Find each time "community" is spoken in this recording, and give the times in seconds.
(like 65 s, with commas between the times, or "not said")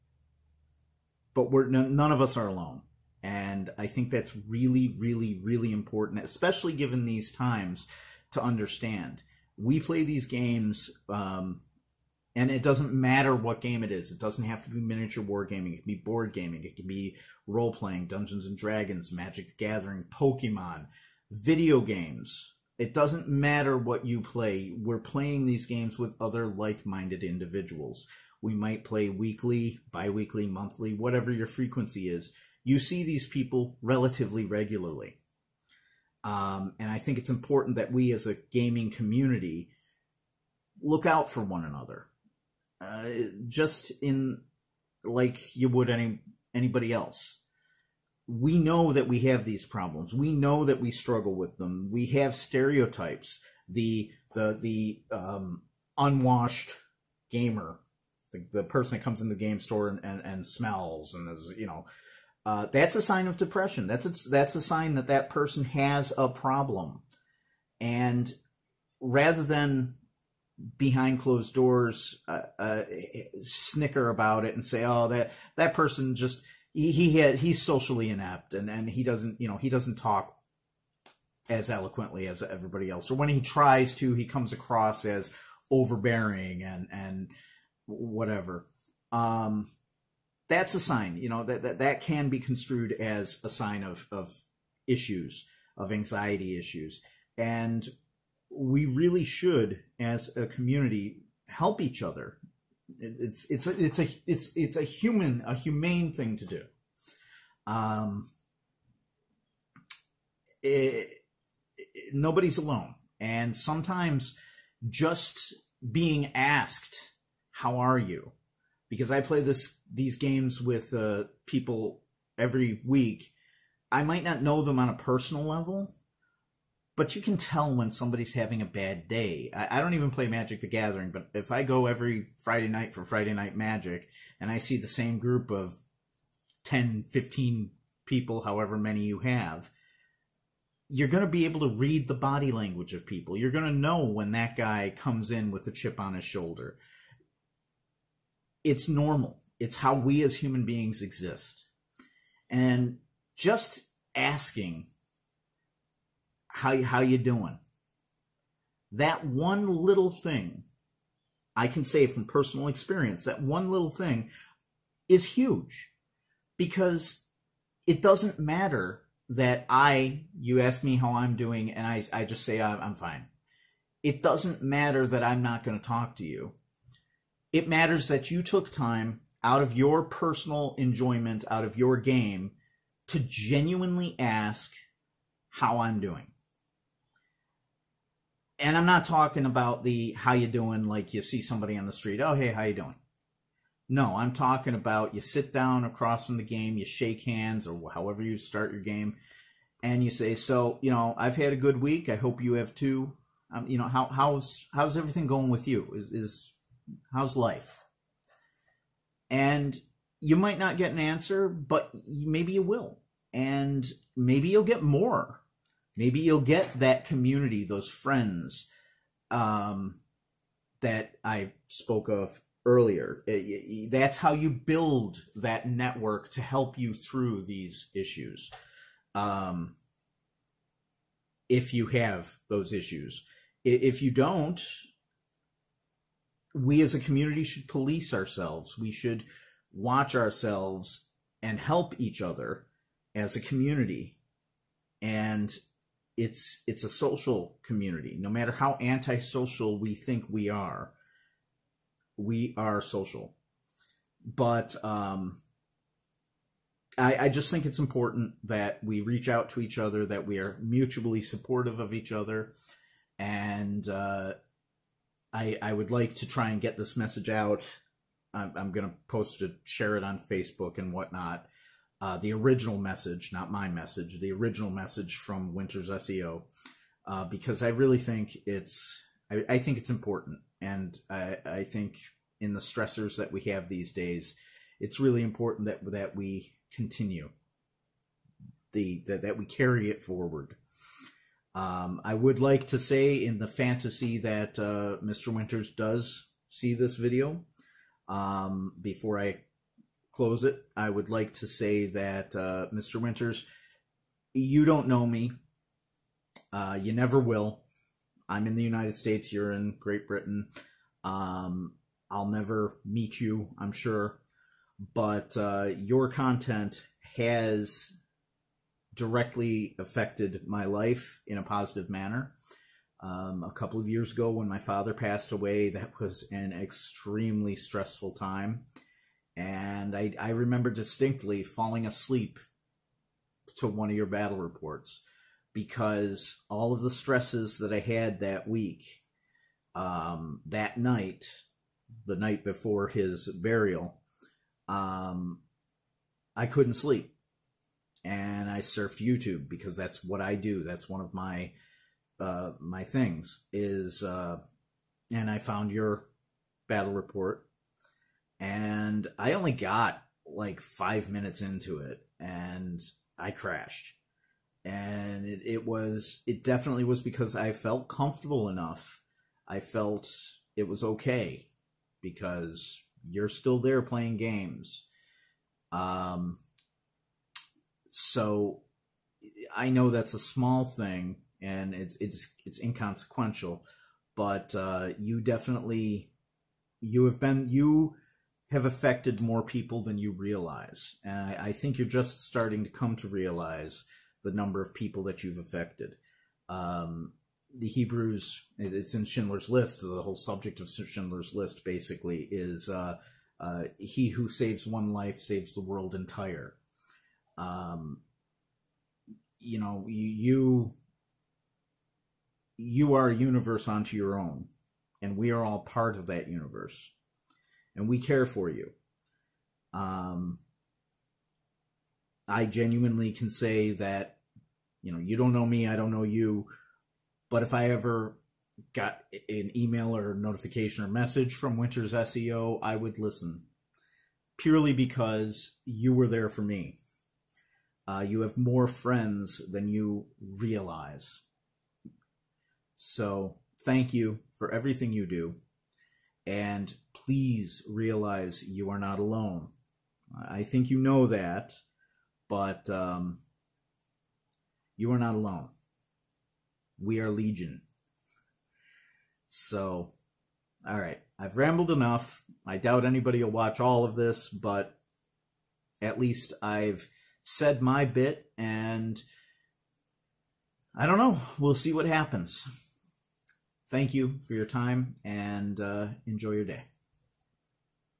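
38 s, 100 s, 217 s, 236 s, 243 s, 247 s.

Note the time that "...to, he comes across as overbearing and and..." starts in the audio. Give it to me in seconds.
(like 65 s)
83 s.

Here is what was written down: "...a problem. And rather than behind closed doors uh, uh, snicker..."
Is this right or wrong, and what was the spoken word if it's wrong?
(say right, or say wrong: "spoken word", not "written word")
right.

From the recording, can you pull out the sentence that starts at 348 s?
And I surfed YouTube because that's what I do.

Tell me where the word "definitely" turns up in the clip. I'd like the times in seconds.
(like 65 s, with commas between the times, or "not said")
366 s, 385 s.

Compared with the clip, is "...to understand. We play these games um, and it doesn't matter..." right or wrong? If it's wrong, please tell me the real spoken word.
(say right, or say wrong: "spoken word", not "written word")
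right.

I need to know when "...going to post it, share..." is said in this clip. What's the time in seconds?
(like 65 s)
268 s.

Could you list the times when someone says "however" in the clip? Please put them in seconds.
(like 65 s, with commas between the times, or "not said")
138 s, 197 s.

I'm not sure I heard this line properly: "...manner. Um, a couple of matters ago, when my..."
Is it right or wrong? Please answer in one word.
wrong.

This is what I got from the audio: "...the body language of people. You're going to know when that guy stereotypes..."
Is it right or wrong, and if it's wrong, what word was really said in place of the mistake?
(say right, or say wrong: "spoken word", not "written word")
wrong: "comes", not "stereotypes".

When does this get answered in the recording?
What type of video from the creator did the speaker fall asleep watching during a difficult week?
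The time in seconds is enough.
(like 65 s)
356 s.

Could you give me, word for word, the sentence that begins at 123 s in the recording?
I might not know them on a personal level, but you can tell when somebody's having a bad day.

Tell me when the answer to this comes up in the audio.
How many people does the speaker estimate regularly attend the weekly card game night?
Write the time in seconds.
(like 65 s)
136 s.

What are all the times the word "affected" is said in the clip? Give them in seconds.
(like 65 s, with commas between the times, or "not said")
319 s, 388 s, 395 s.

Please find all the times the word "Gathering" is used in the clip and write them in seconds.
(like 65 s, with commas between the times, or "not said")
19 s, 130 s.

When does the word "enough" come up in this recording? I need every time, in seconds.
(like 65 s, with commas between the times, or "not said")
368 s, 461 s.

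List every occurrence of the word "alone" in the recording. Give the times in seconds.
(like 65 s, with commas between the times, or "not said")
2 s, 112 s, 448 s, 455 s.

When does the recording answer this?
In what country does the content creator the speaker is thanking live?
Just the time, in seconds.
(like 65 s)
309 s.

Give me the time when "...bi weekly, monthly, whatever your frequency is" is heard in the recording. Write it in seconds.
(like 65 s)
29 s.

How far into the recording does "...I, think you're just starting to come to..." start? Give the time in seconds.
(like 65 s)
391 s.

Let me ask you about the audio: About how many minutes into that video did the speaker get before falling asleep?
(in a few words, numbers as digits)
5.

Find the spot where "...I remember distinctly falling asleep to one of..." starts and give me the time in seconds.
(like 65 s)
330 s.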